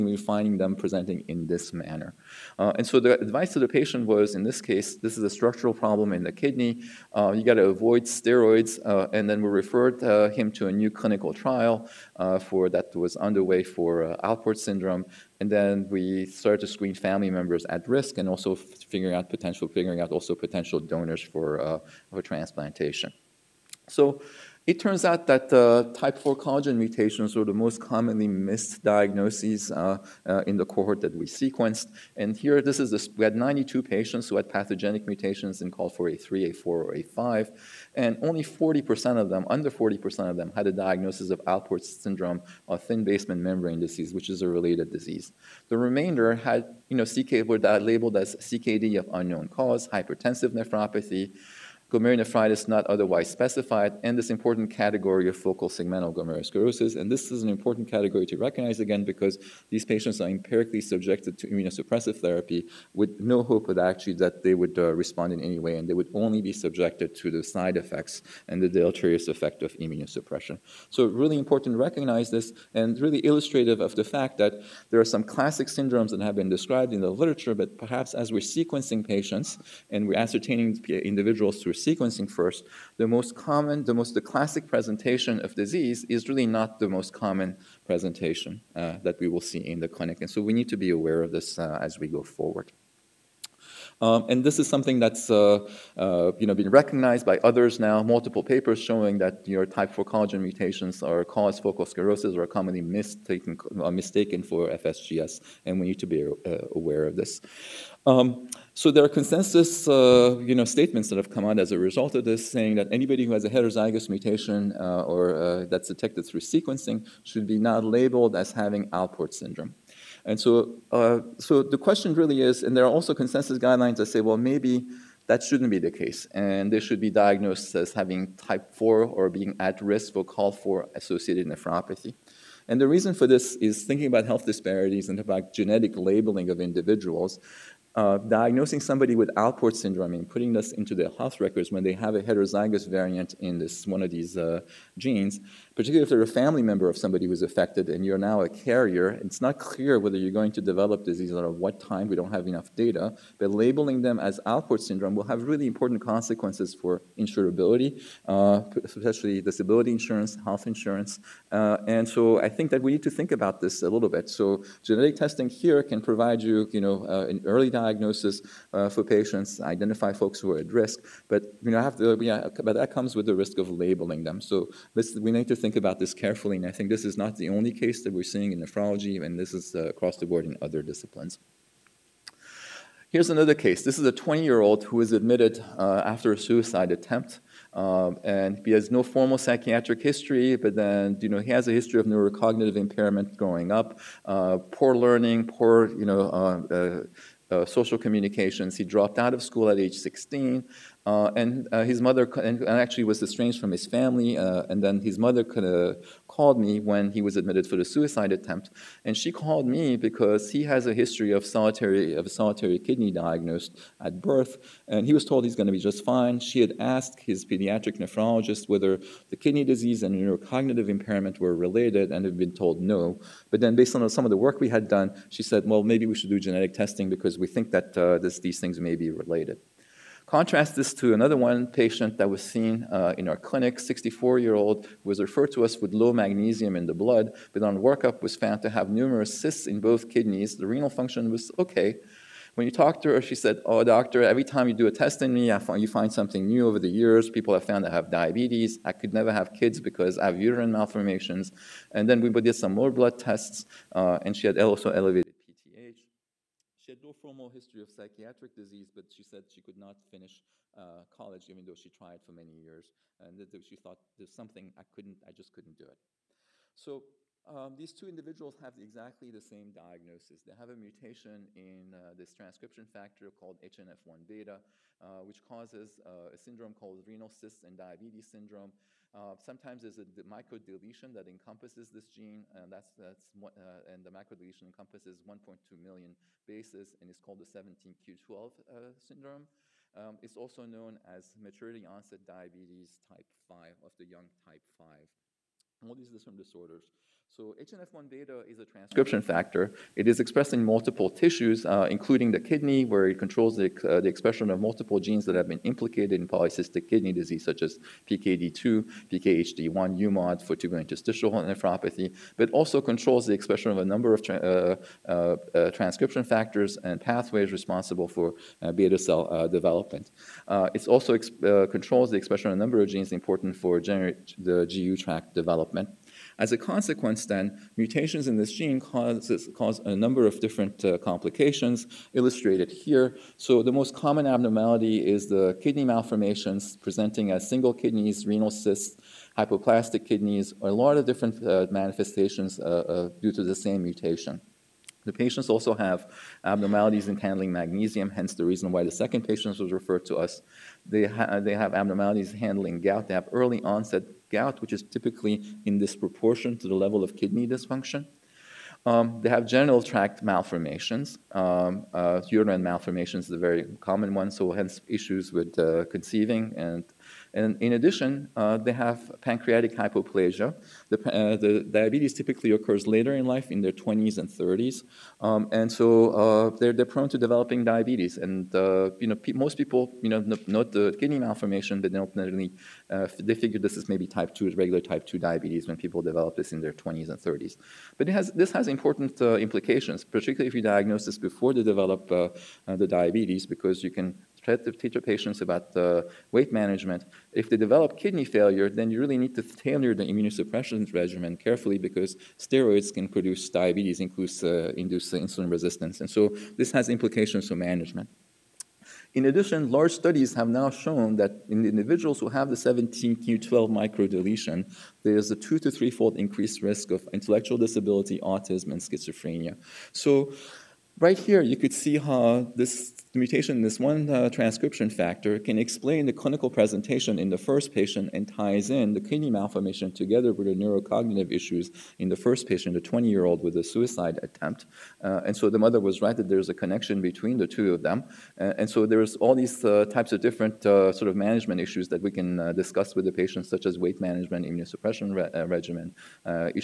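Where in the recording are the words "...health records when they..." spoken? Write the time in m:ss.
2:21.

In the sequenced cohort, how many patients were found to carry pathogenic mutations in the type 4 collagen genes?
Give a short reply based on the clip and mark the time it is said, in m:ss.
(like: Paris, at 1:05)
92, at 0:33.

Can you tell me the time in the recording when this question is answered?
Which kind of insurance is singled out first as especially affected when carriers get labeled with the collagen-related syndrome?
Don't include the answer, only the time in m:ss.
2:39.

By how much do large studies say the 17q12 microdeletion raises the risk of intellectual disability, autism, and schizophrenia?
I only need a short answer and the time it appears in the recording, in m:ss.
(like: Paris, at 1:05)
2 to 3-fold, at 6:55.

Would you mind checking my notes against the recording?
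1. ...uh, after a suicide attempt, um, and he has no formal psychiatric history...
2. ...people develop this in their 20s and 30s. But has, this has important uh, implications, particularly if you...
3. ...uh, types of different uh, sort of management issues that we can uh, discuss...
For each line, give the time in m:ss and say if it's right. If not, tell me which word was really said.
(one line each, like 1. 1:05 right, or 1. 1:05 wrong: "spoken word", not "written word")
1. 3:05 right
2. 6:25 right
3. 7:19 right.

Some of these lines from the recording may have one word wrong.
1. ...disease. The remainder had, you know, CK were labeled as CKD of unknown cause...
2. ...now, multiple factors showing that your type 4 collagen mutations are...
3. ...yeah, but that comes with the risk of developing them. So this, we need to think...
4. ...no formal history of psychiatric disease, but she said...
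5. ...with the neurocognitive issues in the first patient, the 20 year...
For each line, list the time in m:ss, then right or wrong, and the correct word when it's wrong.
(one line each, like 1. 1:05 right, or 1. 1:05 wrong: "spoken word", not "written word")
1. 0:44 right
2. 1:37 wrong: "papers", not "factors"
3. 2:52 wrong: "labeling", not "developing"
4. 4:17 right
5. 7:10 right.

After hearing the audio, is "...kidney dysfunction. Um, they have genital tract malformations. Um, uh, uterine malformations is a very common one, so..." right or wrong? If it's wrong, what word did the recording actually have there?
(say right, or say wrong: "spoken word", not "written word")
right.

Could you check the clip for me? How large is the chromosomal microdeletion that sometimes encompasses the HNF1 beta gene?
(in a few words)
1.2 million bases.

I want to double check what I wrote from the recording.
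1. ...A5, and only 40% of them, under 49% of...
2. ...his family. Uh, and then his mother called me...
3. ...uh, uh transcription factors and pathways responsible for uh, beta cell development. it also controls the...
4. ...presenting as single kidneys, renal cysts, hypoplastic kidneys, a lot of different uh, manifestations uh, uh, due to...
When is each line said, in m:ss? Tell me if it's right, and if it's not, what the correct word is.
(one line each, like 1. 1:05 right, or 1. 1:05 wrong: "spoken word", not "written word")
1. 0:36 wrong: "40", not "49"
2. 3:23 right
3. 5:15 right
4. 5:36 right.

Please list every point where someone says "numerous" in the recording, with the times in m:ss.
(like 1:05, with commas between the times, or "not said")
3:58.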